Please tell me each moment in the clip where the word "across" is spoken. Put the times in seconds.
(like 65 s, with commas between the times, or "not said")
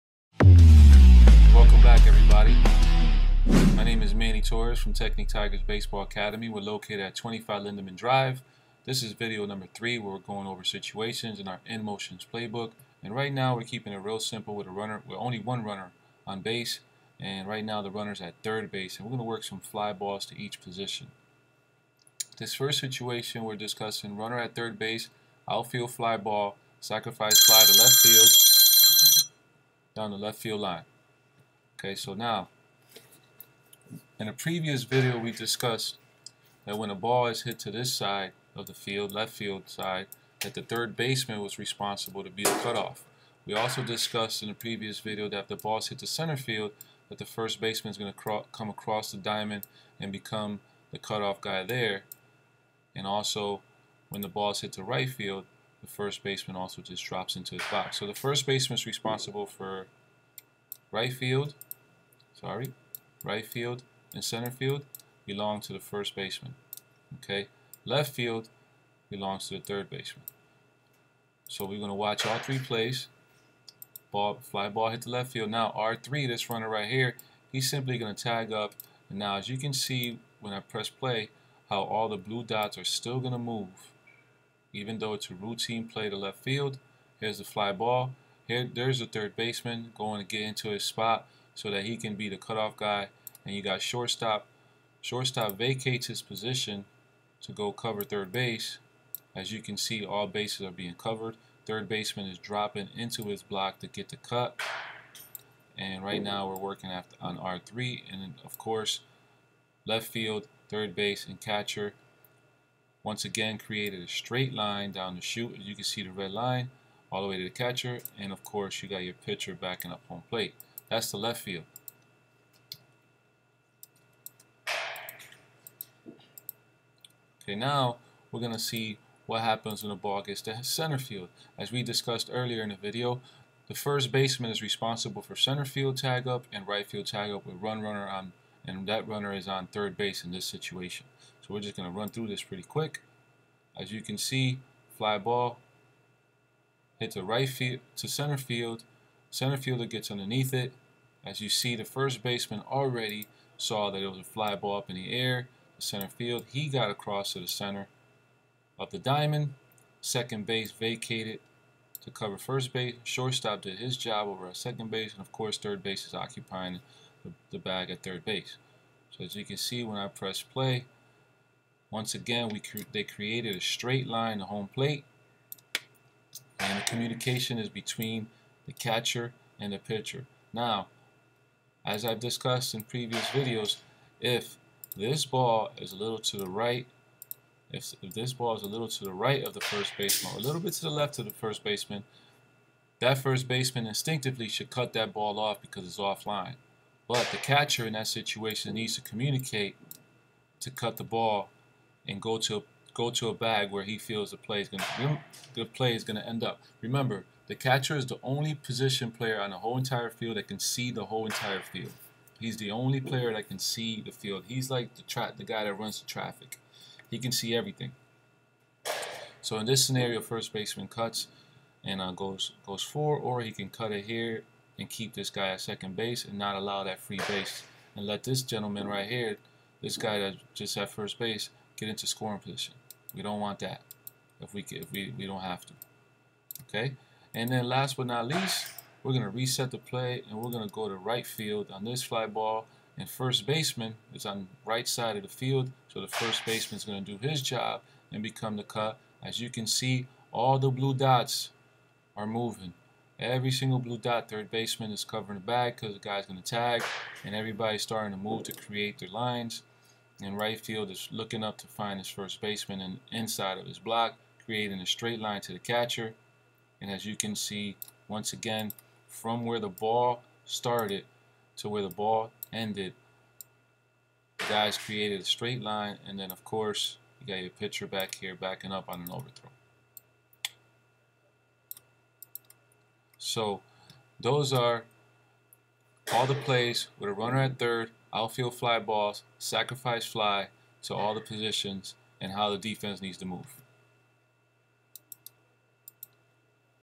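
48 s, 156 s.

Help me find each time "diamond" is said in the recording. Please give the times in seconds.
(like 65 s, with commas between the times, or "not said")
49 s, 158 s.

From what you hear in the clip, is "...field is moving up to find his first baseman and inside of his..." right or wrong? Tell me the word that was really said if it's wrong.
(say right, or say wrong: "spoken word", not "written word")
wrong: "looking", not "moving".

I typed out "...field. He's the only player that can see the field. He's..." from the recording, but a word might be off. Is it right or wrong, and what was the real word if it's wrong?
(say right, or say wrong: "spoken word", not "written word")
right.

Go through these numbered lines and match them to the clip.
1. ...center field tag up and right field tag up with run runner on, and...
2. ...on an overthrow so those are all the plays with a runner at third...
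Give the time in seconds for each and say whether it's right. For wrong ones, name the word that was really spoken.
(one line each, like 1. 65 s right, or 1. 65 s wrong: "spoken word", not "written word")
1. 135 s right
2. 278 s right.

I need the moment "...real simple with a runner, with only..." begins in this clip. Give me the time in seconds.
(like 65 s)
13 s.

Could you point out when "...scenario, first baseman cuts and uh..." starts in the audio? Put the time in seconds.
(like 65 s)
219 s.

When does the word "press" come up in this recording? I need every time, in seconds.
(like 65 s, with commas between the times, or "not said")
80 s, 170 s.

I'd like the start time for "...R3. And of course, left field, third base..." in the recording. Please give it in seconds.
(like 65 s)
107 s.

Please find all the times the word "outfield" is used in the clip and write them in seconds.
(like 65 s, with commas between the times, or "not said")
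25 s, 288 s.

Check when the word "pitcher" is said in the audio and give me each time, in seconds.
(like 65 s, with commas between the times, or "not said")
119 s, 179 s, 277 s.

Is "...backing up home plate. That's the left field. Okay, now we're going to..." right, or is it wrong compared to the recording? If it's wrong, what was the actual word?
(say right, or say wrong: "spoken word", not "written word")
right.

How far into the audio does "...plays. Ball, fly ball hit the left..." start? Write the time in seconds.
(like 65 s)
72 s.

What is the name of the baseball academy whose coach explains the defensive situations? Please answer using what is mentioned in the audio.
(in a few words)
Technique Tigers Baseball Academy.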